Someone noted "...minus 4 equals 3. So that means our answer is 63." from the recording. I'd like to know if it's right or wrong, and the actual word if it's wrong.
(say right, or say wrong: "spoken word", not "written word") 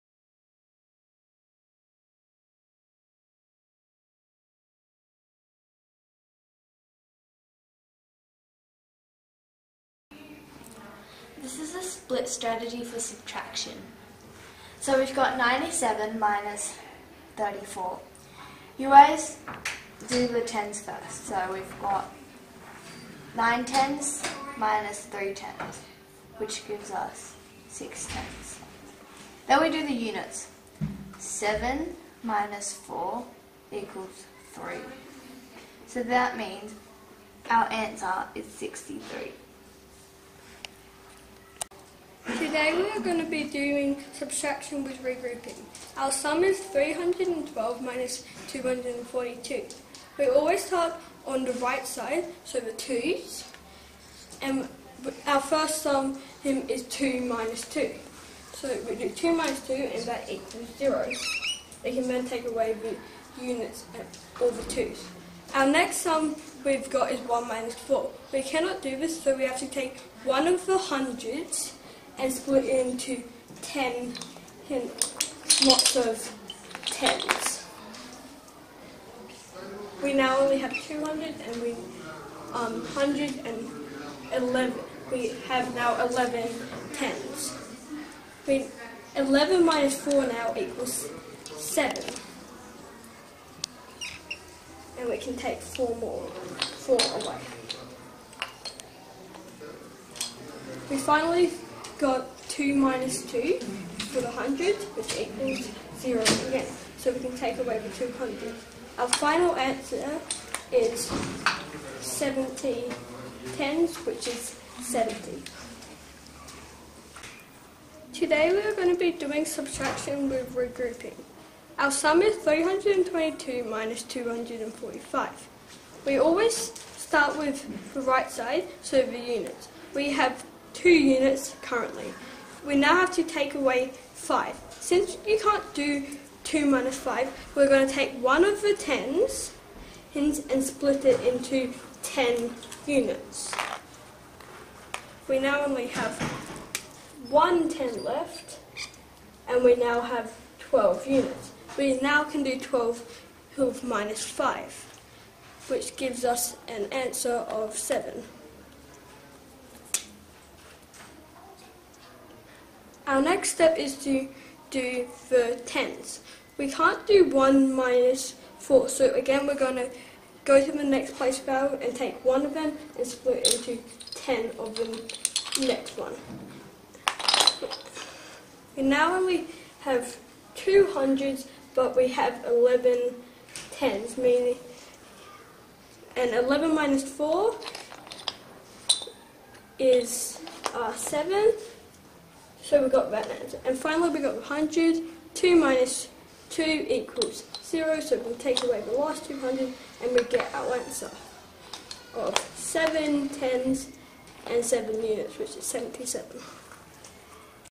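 right.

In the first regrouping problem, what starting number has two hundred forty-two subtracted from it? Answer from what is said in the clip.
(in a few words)
312.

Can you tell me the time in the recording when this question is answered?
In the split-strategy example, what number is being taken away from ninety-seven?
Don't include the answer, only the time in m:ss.
0:17.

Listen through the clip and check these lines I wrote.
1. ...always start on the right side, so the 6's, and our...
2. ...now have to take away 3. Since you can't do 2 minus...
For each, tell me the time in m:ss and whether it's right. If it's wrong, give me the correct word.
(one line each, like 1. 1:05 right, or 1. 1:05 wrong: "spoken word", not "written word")
1. 0:50 wrong: "2", not "6"
2. 2:12 wrong: "5", not "3".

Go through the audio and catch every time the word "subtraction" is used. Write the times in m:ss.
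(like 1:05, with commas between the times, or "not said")
0:12, 0:44, 1:59.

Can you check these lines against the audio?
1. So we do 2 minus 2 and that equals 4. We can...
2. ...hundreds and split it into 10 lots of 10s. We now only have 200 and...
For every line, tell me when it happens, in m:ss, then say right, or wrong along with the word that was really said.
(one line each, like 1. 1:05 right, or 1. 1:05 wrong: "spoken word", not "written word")
1. 0:58 wrong: "0", not "4"
2. 1:10 right.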